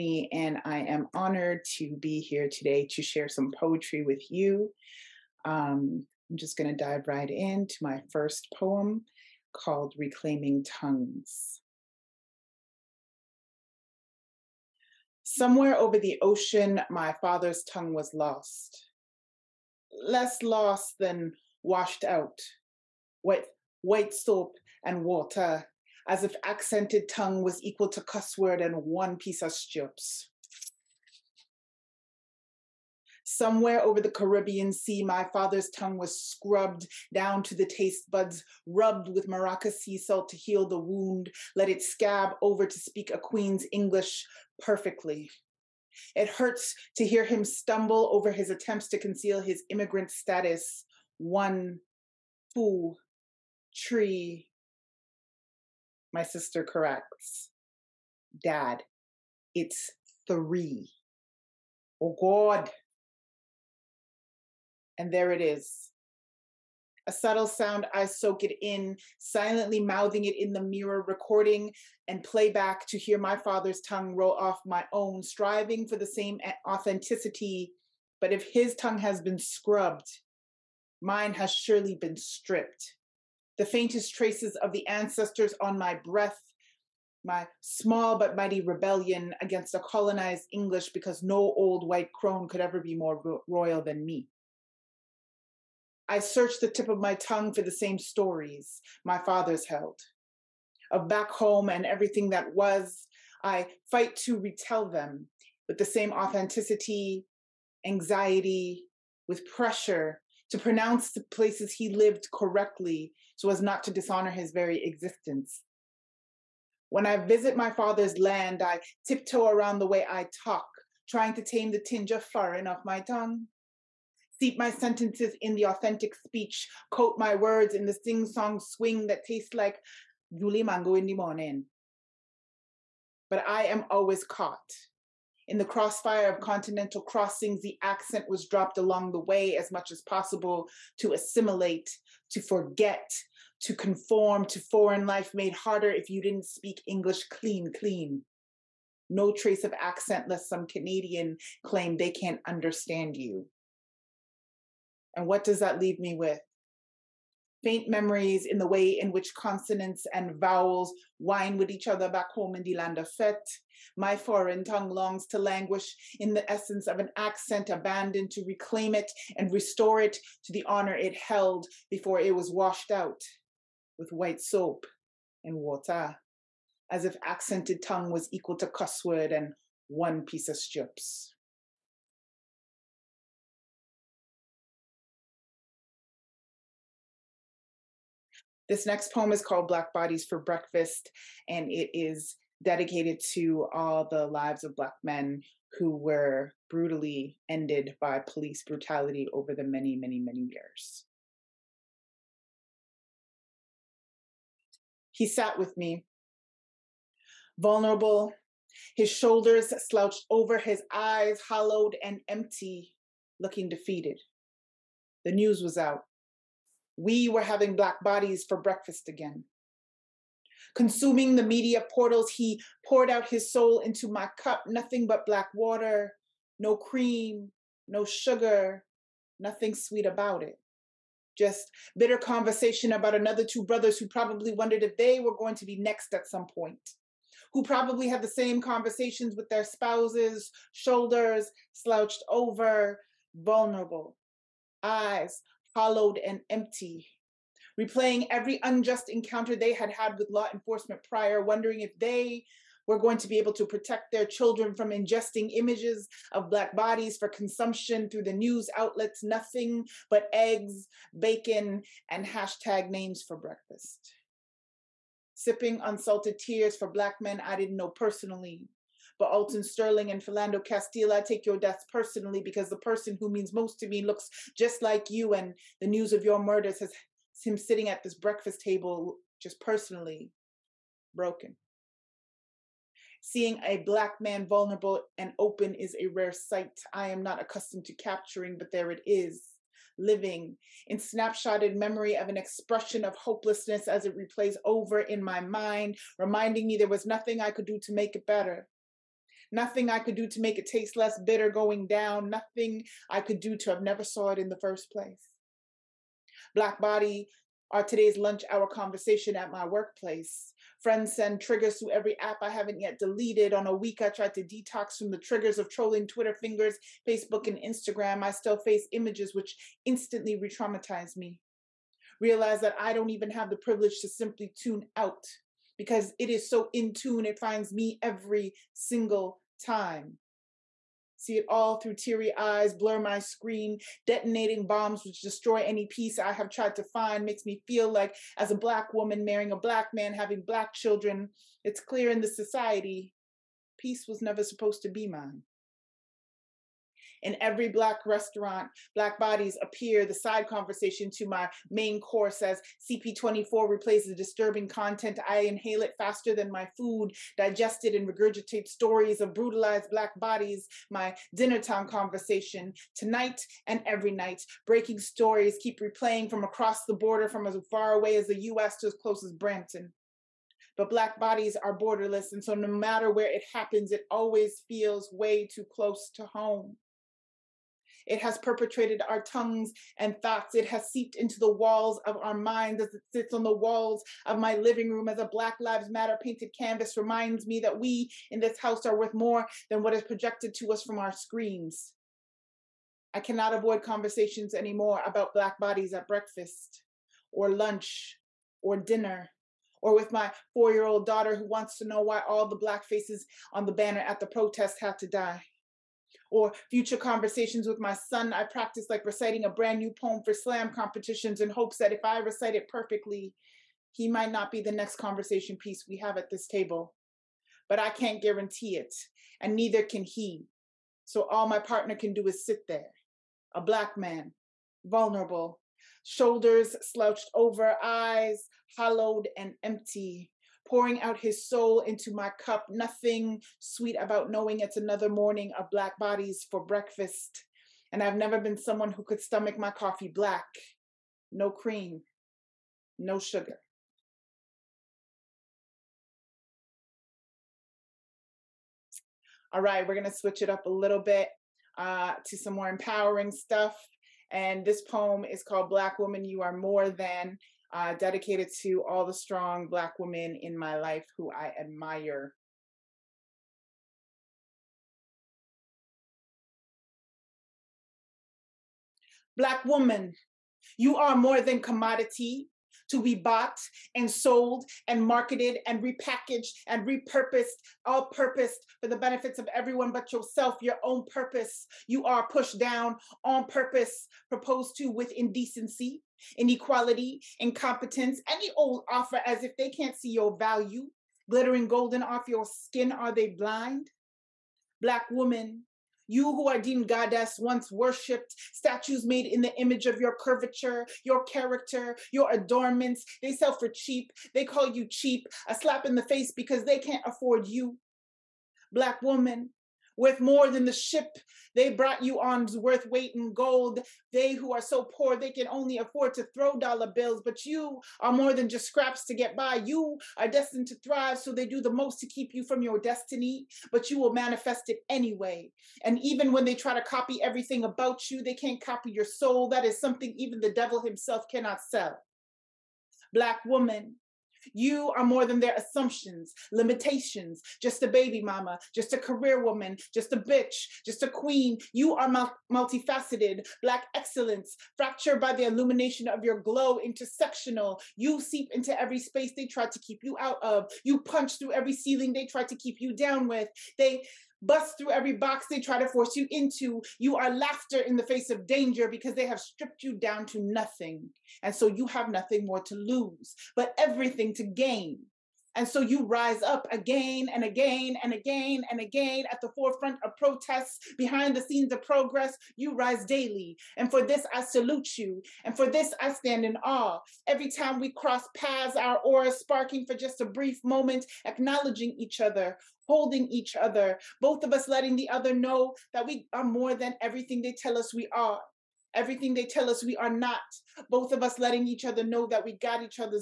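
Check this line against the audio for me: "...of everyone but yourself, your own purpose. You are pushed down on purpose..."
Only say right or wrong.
right.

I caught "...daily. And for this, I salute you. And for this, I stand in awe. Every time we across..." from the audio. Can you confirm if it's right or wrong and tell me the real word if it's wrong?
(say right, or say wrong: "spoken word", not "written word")
wrong: "cross", not "across".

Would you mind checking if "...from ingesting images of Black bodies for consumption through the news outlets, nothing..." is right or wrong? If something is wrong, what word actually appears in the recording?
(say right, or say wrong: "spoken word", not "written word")
right.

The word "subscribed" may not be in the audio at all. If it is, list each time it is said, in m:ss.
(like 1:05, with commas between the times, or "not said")
not said.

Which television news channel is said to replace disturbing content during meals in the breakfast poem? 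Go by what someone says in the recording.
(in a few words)
CP24.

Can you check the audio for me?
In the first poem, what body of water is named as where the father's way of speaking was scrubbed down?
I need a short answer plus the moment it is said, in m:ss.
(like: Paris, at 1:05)
Caribbean Sea, at 0:34.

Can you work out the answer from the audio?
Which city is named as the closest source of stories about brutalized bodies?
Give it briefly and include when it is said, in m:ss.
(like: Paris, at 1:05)
Brampton, at 6:09.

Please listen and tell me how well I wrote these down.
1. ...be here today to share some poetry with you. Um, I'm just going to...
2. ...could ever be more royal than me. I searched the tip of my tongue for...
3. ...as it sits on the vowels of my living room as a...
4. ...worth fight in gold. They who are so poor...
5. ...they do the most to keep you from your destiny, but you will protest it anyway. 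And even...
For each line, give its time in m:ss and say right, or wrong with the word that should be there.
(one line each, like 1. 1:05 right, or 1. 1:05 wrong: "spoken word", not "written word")
1. 0:01 right
2. 1:32 right
3. 6:22 wrong: "walls", not "vowels"
4. 8:32 wrong: "weight", not "fight"
5. 8:41 wrong: "manifest", not "protest".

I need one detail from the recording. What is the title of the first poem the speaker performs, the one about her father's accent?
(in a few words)
Reclaiming Tongues.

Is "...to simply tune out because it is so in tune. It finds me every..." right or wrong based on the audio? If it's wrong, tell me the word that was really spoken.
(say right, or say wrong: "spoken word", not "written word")
right.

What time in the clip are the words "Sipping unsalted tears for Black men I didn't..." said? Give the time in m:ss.
4:25.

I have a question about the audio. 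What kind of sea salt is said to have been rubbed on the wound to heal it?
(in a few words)
Maraca sea salt.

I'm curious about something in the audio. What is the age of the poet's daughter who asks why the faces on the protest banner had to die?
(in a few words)
4.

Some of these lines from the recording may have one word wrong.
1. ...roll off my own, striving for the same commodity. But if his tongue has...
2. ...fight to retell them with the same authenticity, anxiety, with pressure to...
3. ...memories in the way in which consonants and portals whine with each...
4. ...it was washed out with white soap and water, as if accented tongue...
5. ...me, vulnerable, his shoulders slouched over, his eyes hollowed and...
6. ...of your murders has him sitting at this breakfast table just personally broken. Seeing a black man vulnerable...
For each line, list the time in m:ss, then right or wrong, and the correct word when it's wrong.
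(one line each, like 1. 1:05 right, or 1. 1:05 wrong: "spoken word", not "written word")
1. 1:14 wrong: "authenticity", not "commodity"
2. 1:43 right
3. 2:37 wrong: "vowels", not "portals"
4. 2:52 right
5. 3:25 right
6. 4:36 right.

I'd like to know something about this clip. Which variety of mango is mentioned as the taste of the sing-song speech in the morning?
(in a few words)
Yuli Mango.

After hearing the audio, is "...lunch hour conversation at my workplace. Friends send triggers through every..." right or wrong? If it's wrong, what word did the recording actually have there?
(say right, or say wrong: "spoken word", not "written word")
right.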